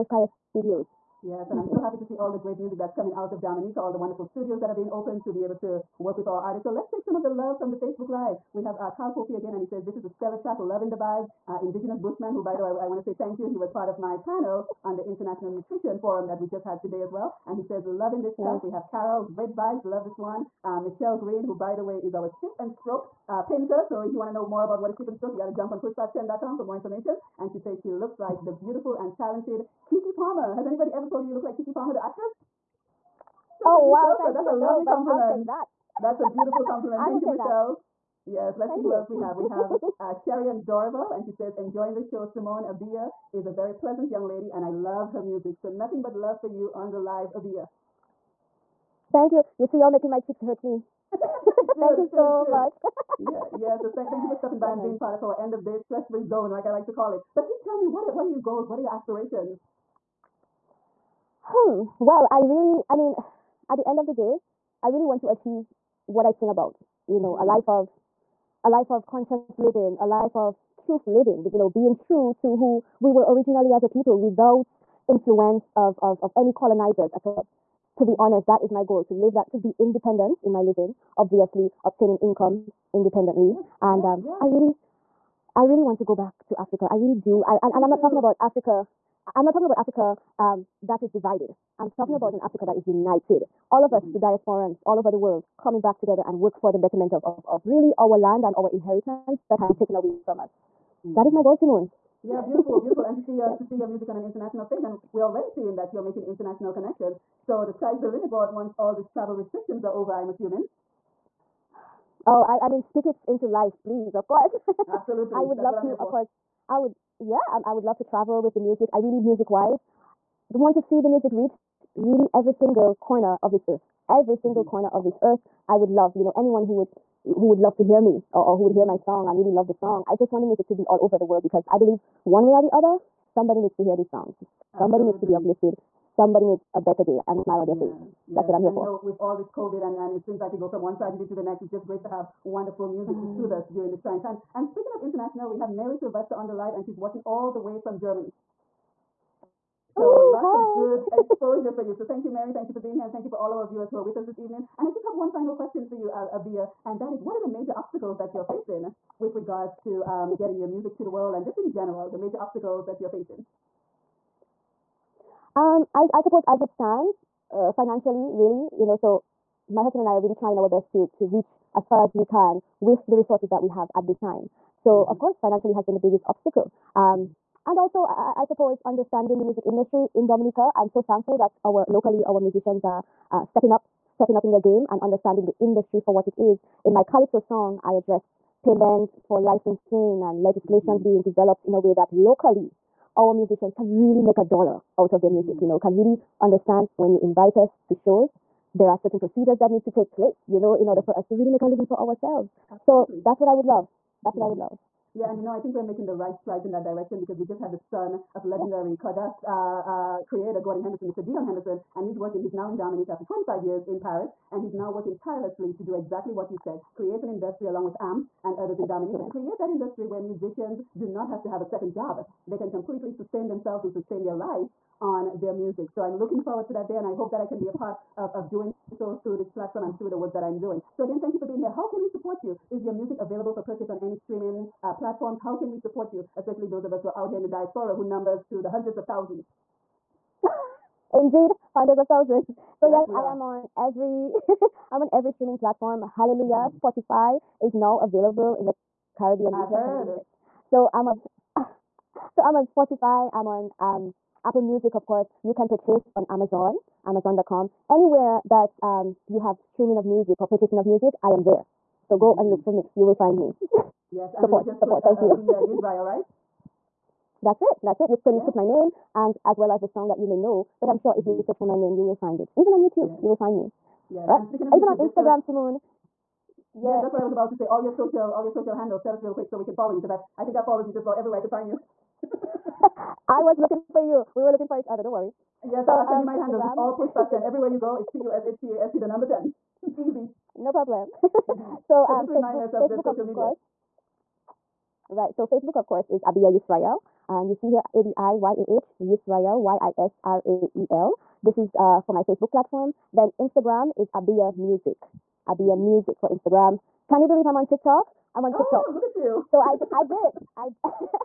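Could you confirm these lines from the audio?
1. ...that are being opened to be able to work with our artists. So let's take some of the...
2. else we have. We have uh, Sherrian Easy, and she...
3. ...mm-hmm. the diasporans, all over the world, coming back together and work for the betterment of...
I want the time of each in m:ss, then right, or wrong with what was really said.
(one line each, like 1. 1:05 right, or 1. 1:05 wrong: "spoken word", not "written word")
1. 0:04 right
2. 0:38 wrong: "Dorable", not "Easy"
3. 1:34 right.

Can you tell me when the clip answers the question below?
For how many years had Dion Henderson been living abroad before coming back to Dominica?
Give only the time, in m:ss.
3:33.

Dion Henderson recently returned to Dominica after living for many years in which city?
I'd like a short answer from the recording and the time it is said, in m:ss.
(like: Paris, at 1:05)
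Paris, at 3:34.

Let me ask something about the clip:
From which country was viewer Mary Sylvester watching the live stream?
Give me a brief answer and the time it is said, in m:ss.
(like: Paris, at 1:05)
Germany, at 2:27.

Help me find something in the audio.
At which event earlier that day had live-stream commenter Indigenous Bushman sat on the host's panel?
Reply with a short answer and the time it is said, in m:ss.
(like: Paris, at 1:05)
International Nutrition Forum, at 0:15.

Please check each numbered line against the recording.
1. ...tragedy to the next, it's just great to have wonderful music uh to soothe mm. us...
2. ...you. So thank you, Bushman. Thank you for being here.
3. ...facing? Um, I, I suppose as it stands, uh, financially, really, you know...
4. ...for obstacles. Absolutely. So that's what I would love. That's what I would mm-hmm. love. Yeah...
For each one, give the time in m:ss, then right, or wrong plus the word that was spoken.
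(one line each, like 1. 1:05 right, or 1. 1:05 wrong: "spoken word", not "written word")
1. 2:20 right
2. 2:31 wrong: "Mary", not "Bushman"
3. 2:43 right
4. 3:21 wrong: "ourselves", not "obstacles".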